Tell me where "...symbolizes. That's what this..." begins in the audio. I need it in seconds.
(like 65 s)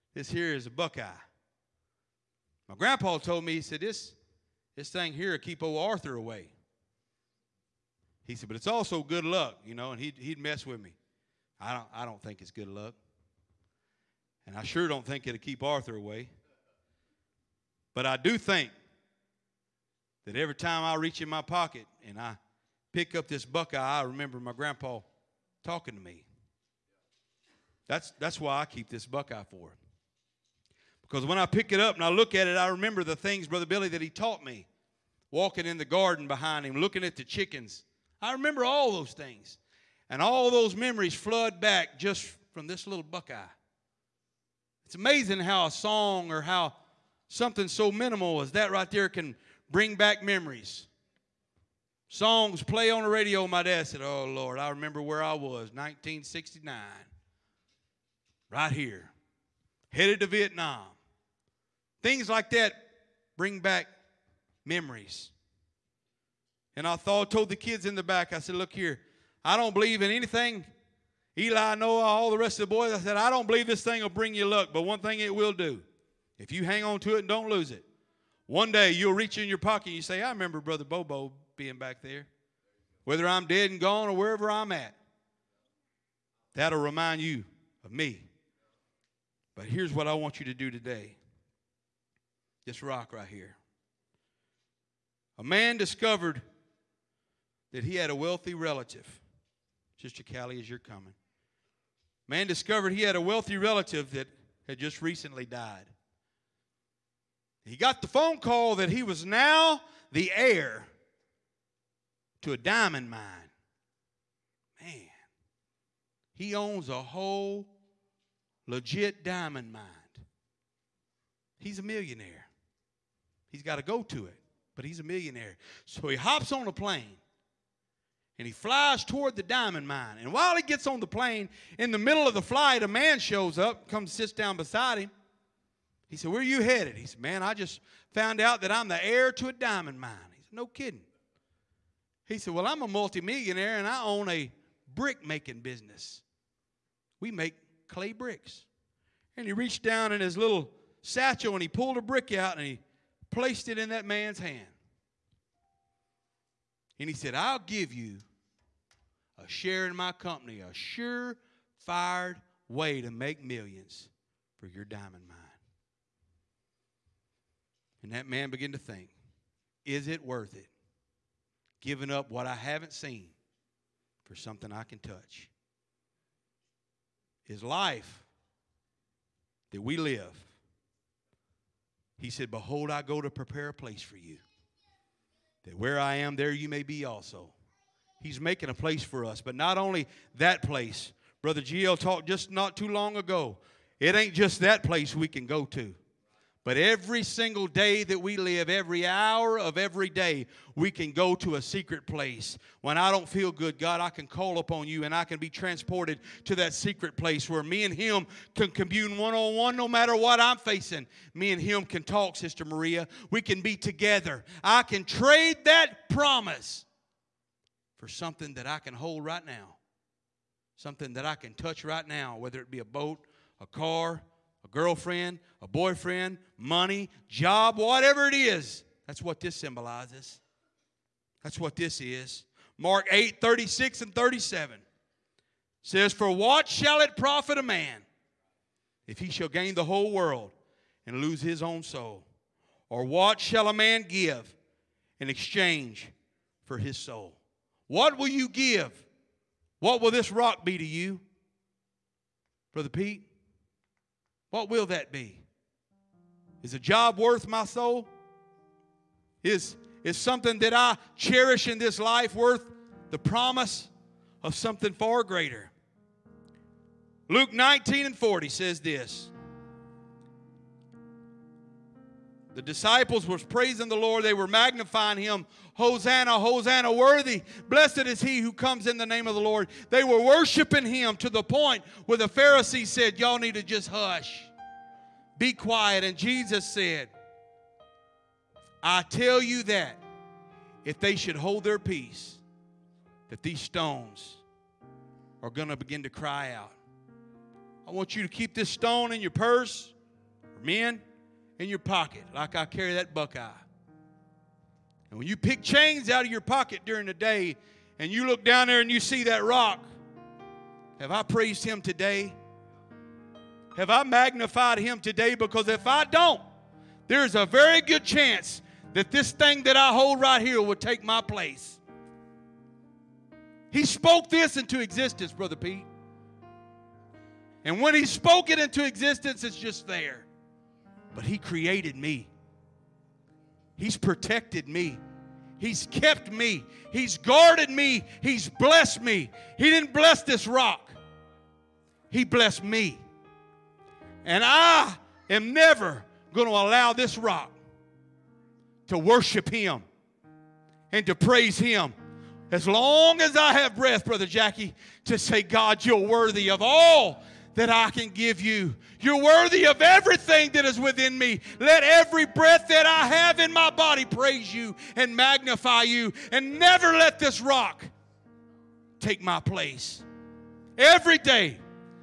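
229 s.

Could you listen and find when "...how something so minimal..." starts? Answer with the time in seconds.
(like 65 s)
46 s.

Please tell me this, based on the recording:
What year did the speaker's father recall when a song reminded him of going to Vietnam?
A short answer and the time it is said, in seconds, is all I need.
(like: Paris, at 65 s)
1969, at 55 s.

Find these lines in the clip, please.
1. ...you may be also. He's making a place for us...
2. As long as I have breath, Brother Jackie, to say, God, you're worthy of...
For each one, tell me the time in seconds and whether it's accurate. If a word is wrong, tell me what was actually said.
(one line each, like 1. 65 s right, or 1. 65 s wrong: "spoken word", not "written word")
1. 186 s right
2. 352 s right.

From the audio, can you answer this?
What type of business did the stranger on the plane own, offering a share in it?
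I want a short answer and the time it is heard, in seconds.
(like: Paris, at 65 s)
Brick making, at 144 s.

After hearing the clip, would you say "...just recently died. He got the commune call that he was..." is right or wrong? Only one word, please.
wrong.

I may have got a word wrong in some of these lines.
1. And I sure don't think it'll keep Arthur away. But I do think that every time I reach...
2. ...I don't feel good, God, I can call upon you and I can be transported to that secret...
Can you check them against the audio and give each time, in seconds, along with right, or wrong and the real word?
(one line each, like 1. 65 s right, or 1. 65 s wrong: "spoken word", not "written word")
1. 14 s right
2. 202 s right.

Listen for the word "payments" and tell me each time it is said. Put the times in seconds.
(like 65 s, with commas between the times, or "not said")
not said.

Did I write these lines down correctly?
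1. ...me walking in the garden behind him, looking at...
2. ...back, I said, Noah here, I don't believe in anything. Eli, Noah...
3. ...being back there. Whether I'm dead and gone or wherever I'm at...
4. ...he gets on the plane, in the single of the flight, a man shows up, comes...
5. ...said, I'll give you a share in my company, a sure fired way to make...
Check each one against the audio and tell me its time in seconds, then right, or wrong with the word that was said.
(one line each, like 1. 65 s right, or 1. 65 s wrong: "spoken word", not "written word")
1. 34 s right
2. 68 s wrong: "Look", not "Noah"
3. 81 s right
4. 130 s wrong: "middle", not "single"
5. 157 s right.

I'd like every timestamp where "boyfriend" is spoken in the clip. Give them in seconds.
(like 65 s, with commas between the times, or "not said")
225 s.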